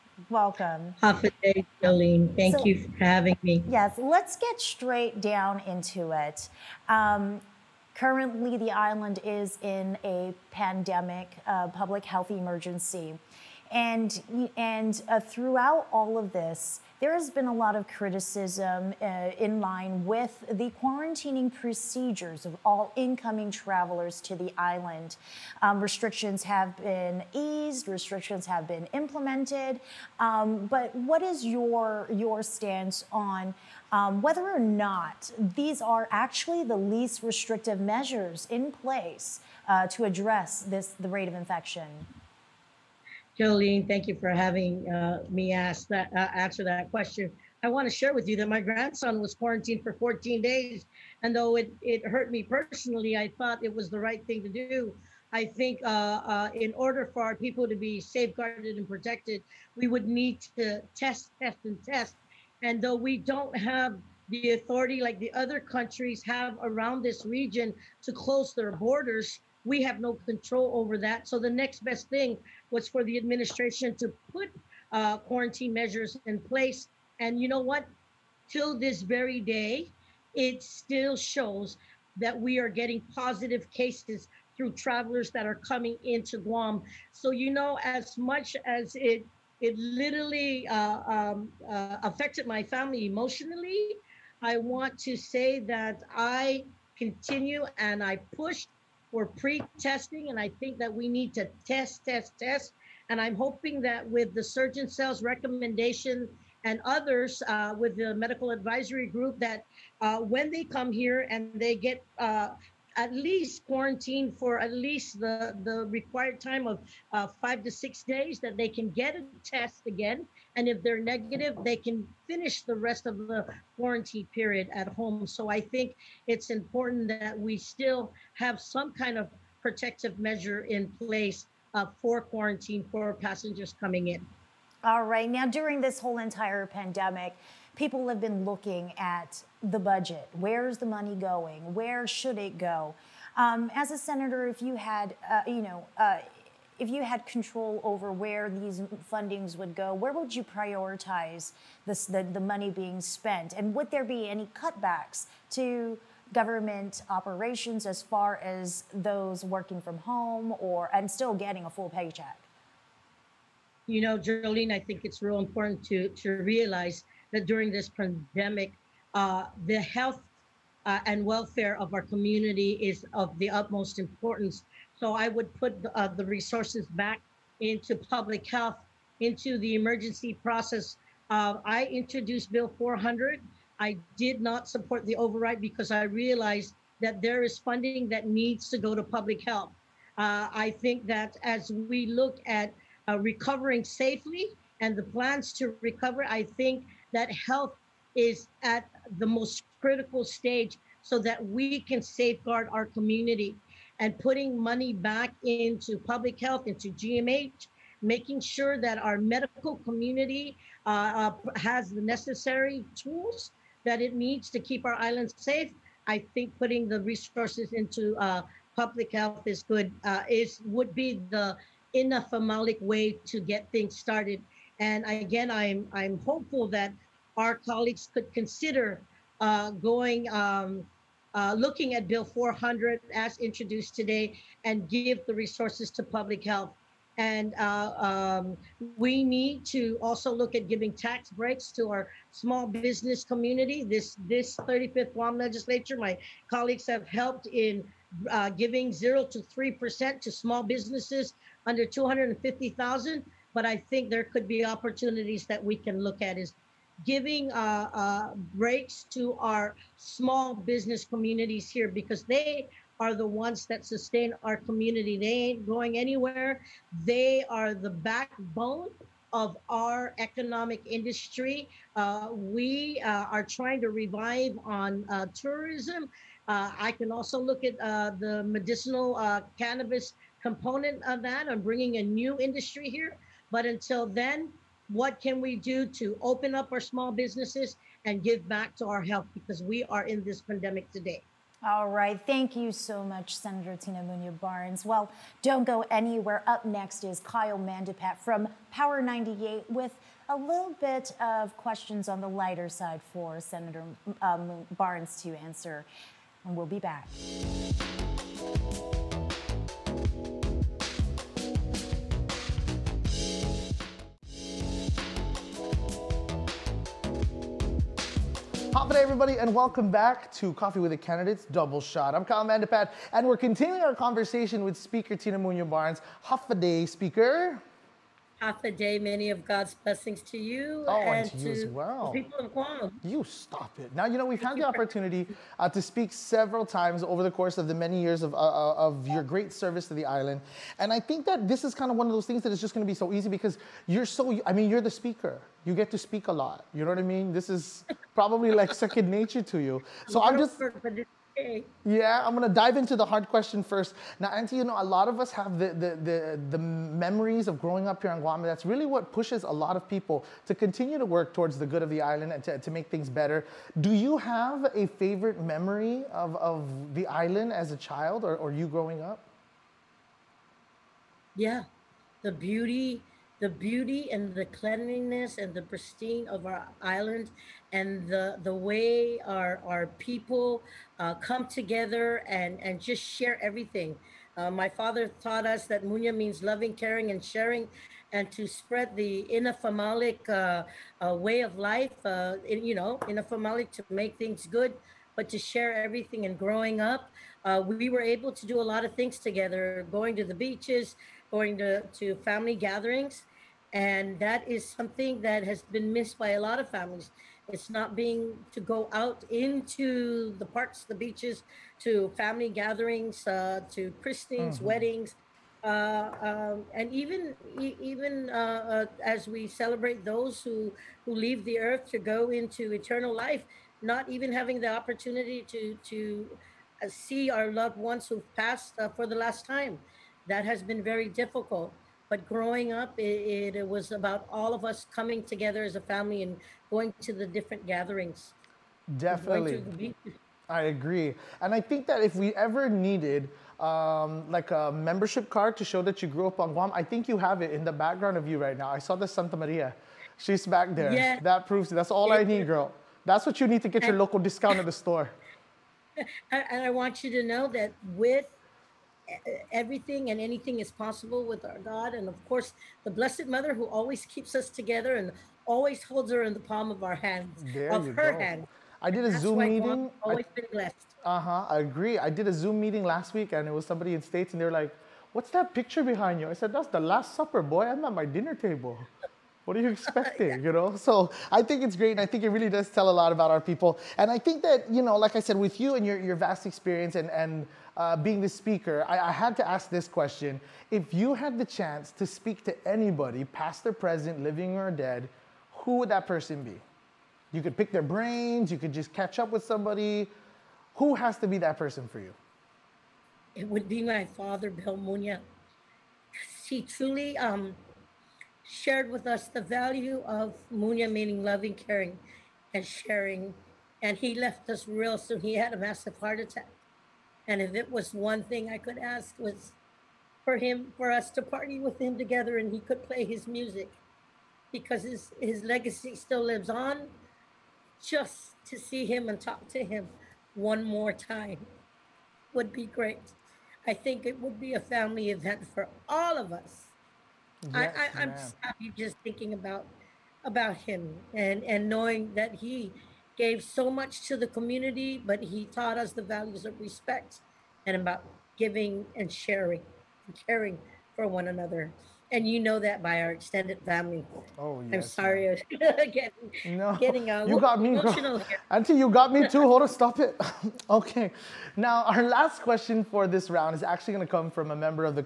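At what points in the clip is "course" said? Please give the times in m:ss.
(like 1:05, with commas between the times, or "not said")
5:37, 7:42.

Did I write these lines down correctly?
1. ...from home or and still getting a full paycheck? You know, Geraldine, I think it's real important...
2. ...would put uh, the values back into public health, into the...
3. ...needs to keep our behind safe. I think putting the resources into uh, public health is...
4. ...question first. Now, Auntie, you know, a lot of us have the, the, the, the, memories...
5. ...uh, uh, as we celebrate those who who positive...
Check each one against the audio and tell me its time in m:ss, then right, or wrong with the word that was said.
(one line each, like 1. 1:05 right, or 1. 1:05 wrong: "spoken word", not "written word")
1. 2:39 right
2. 2:55 wrong: "resources", not "values"
3. 3:34 wrong: "island", not "behind"
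4. 5:53 right
5. 6:58 wrong: "leave", not "positive".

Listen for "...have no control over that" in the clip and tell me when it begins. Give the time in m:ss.
1:09.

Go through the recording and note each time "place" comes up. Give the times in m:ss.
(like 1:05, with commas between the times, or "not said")
0:38, 1:16, 2:10.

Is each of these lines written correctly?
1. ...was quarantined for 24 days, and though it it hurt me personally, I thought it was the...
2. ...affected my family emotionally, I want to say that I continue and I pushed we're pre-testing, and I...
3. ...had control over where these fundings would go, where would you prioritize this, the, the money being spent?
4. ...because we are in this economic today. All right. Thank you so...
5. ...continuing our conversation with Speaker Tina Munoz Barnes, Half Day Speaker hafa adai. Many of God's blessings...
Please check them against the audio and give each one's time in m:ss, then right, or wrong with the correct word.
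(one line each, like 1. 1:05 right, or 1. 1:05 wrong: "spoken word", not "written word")
1. 0:49 wrong: "14", not "24"
2. 1:32 right
3. 2:27 right
4. 4:49 wrong: "pandemic", not "economic"
5. 5:23 right.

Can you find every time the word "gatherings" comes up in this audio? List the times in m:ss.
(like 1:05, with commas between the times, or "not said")
6:42, 6:52, 7:17.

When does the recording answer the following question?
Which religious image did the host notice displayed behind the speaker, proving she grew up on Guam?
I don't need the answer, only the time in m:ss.
7:29.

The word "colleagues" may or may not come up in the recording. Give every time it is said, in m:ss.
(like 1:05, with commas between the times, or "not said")
3:47, 4:06.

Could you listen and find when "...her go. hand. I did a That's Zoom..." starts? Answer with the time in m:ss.
7:47.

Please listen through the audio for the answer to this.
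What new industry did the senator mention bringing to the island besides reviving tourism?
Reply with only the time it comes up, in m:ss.
4:38.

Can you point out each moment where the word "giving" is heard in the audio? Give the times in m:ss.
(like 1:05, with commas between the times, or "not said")
4:00, 4:08, 4:17, 9:08.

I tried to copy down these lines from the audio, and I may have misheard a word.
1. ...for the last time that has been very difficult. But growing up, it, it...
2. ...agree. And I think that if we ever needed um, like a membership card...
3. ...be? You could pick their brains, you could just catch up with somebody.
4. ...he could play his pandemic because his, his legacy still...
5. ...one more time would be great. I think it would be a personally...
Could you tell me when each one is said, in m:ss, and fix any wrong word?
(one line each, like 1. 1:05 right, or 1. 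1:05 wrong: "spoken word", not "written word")
1. 7:08 right
2. 7:20 right
3. 8:16 right
4. 8:42 wrong: "music", not "pandemic"
5. 8:50 wrong: "family", not "personally".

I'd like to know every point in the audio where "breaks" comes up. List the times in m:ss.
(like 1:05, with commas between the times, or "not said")
4:01, 4:18.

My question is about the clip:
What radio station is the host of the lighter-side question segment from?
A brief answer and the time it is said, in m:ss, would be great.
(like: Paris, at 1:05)
Power 98, at 4:58.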